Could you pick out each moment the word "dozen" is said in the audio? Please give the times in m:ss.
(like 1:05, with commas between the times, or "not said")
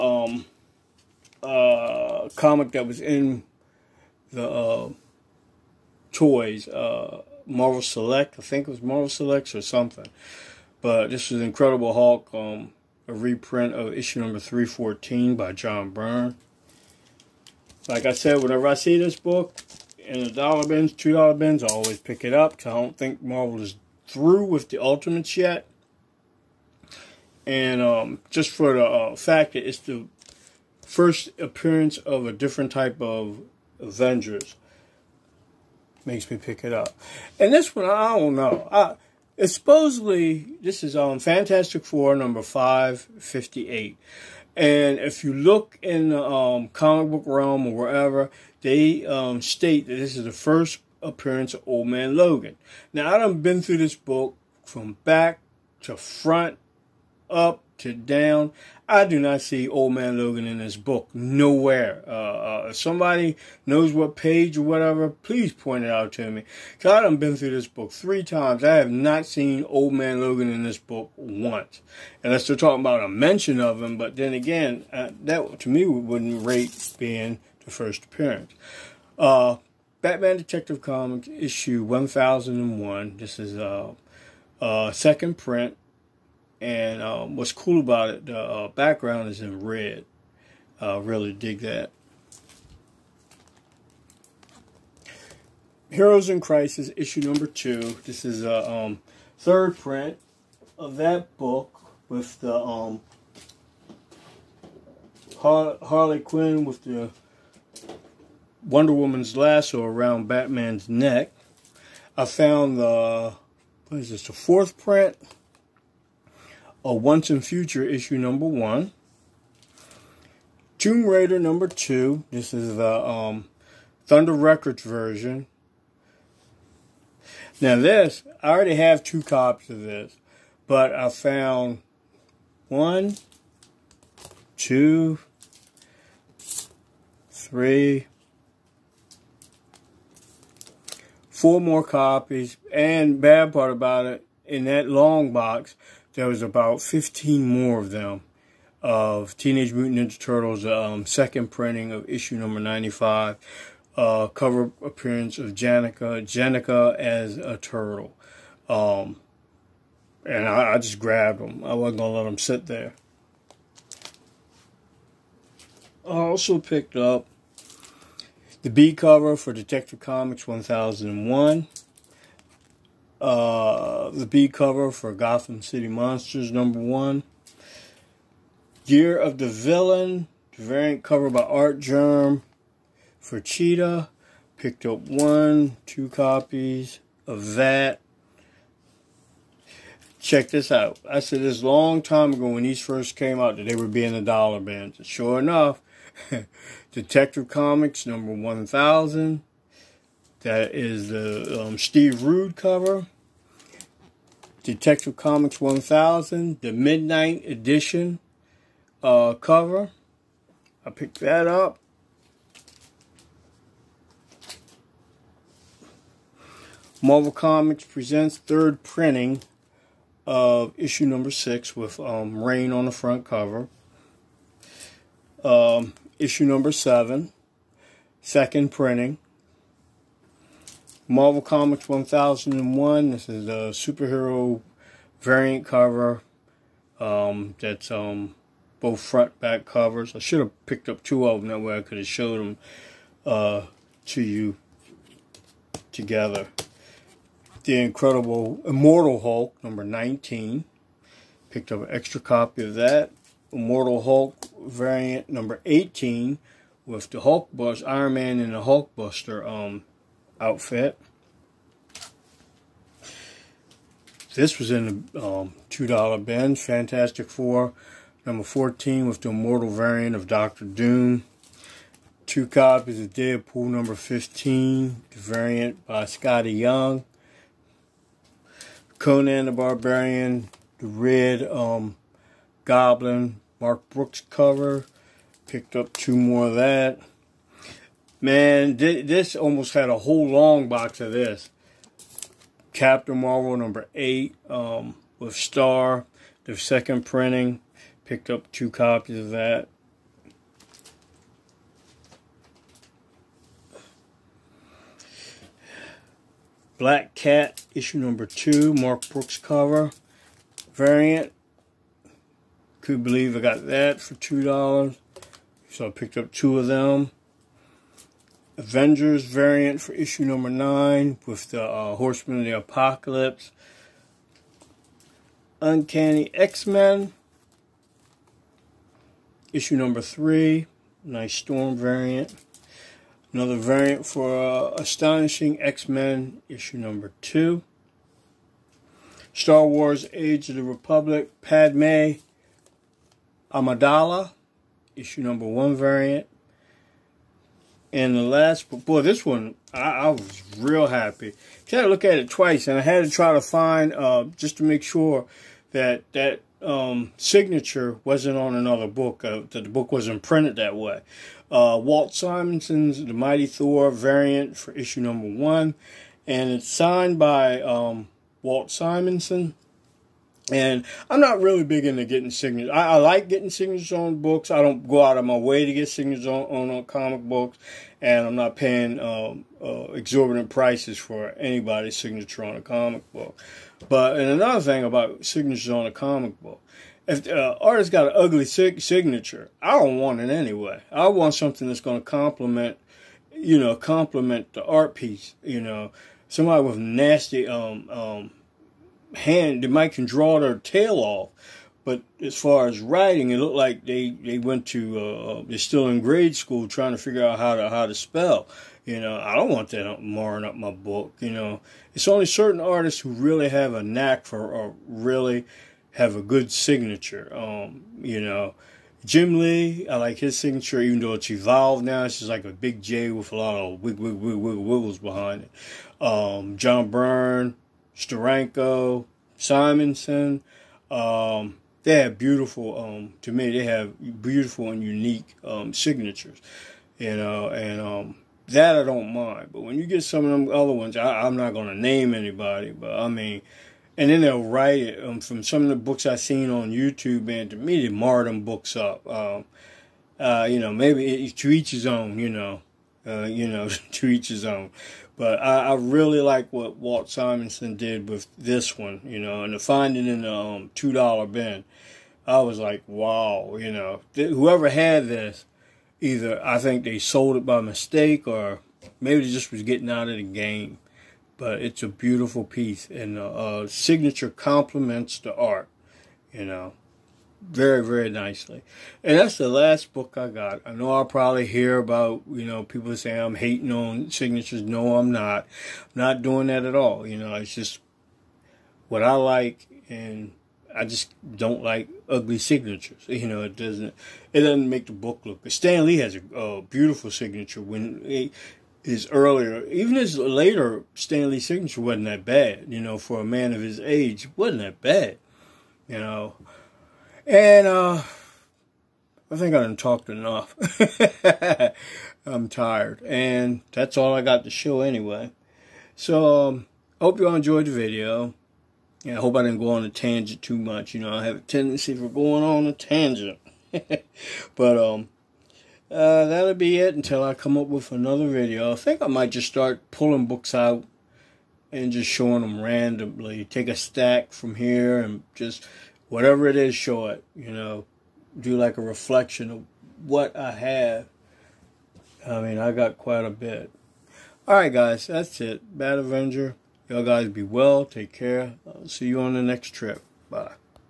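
not said.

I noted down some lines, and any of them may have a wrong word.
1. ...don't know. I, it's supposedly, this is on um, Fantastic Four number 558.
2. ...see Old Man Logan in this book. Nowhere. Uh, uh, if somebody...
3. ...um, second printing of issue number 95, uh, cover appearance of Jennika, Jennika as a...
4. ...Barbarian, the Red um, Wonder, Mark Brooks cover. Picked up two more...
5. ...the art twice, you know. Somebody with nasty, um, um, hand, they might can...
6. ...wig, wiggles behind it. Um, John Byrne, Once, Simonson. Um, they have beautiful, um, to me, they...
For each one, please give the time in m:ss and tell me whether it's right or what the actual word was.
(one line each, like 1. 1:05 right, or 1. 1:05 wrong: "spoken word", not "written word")
1. 0:38 right
2. 0:59 right
3. 2:30 right
4. 4:39 wrong: "Goblin", not "Wonder"
5. 6:34 wrong: "piece", not "twice"
6. 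7:04 wrong: "Steranko", not "Once".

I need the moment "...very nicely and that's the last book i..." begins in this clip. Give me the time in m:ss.
7:57.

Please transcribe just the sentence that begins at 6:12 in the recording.
I, I, like getting signatures on books.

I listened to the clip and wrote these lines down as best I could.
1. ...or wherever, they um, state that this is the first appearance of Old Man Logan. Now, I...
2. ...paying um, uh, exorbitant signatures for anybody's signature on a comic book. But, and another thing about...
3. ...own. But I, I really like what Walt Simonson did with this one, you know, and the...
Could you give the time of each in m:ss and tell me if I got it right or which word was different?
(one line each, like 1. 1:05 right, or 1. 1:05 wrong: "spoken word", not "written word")
1. 0:47 right
2. 6:18 wrong: "prices", not "signatures"
3. 7:34 right.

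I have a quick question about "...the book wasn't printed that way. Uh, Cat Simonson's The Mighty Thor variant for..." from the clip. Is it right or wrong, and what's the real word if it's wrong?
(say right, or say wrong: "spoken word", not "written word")
wrong: "Walt", not "Cat".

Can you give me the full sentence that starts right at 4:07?
The Incredible Immortal Hulk number 19.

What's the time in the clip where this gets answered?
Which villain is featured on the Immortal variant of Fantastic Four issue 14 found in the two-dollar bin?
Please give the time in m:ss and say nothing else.
4:30.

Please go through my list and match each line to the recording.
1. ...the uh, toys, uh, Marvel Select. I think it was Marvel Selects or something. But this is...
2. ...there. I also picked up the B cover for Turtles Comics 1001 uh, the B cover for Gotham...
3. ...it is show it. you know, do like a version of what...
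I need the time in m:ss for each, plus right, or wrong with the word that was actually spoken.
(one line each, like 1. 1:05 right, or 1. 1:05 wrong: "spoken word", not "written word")
1. 0:04 right
2. 2:42 wrong: "Detective", not "Turtles"
3. 8:56 wrong: "reflection", not "version".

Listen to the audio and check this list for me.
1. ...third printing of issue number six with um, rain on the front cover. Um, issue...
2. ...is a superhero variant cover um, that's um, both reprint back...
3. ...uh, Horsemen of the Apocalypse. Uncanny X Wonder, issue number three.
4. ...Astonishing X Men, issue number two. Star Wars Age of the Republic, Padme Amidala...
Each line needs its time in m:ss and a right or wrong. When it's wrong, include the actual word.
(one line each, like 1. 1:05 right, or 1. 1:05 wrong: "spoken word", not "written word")
1. 3:38 right
2. 3:53 wrong: "front", not "reprint"
3. 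5:21 wrong: "Men", not "Wonder"
4. 5:34 right.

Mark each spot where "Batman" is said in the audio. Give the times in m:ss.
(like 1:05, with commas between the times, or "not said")
1:20, 1:50.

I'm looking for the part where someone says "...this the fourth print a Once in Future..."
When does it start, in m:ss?
1:54.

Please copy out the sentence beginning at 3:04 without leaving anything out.
Picked up one, two copies of that.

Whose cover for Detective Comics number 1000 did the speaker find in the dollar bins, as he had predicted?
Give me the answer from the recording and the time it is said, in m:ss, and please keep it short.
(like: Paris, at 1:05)
Steve Rude, at 3:21.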